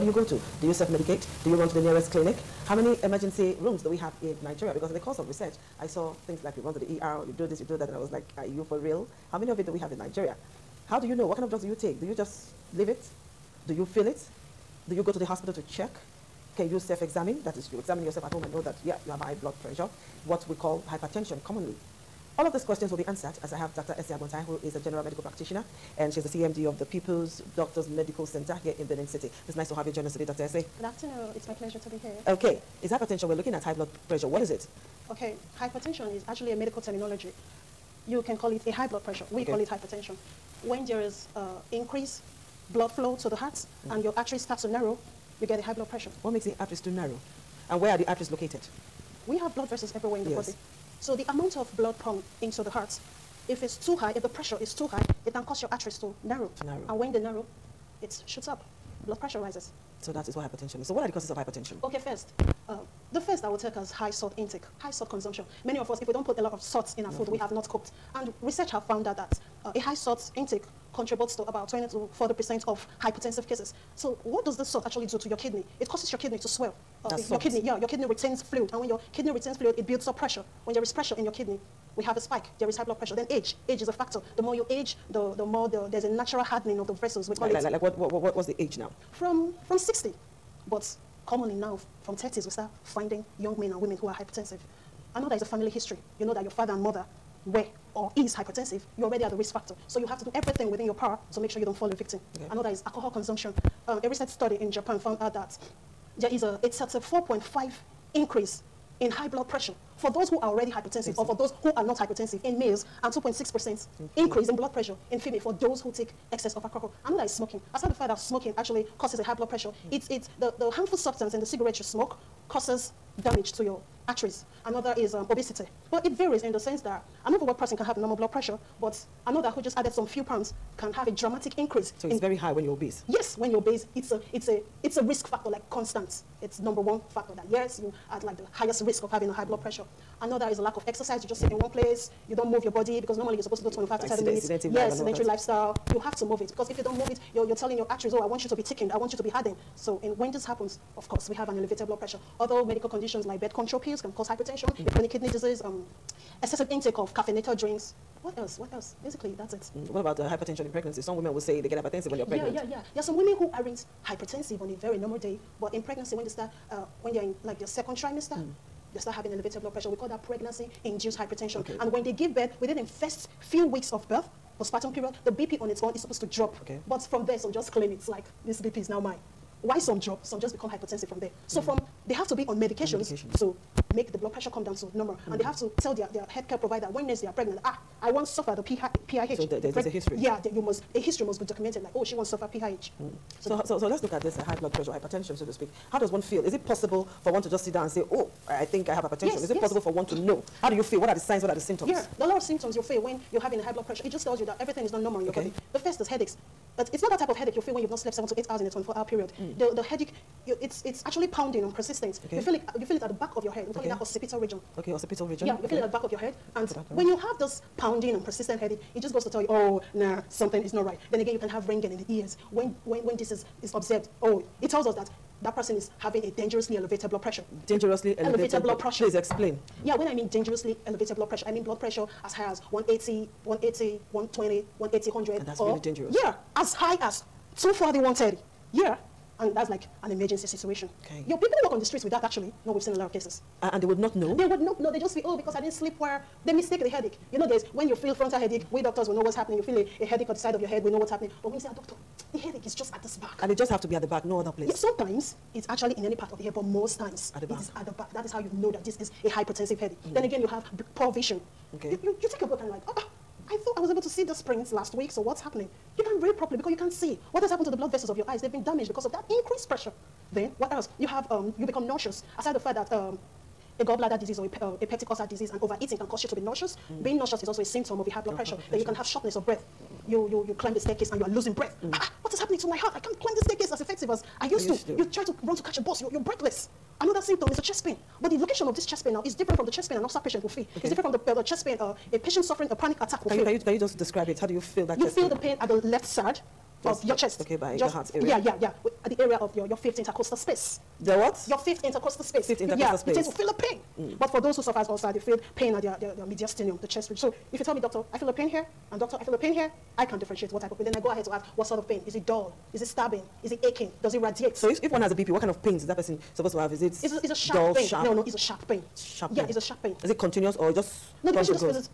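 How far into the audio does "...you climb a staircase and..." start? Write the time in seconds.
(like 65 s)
280 s.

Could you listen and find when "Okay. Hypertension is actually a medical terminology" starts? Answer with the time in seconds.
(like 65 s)
35 s.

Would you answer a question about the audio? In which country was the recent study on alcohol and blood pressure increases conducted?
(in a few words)
Japan.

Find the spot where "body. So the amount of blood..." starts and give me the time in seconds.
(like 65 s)
50 s.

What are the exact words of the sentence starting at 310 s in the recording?
Then I go ahead to ask, what sort of pain?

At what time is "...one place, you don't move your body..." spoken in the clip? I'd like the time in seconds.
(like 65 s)
141 s.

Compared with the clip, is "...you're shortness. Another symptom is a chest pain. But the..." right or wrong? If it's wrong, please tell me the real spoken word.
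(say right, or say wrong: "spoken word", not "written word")
wrong: "breathless", not "shortness".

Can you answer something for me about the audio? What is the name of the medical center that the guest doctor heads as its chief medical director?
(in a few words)
People's Doctors Medical Center.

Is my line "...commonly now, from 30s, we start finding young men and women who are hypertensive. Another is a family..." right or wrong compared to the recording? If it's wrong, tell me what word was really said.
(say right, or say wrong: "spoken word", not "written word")
right.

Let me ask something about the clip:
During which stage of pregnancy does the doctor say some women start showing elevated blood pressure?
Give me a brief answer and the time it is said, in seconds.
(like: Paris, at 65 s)
Second trimester, at 167 s.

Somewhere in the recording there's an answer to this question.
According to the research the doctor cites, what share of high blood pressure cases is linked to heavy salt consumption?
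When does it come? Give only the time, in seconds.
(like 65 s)
71 s.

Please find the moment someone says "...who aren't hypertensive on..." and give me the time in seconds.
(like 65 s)
163 s.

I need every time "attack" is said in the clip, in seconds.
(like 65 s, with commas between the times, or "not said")
293 s.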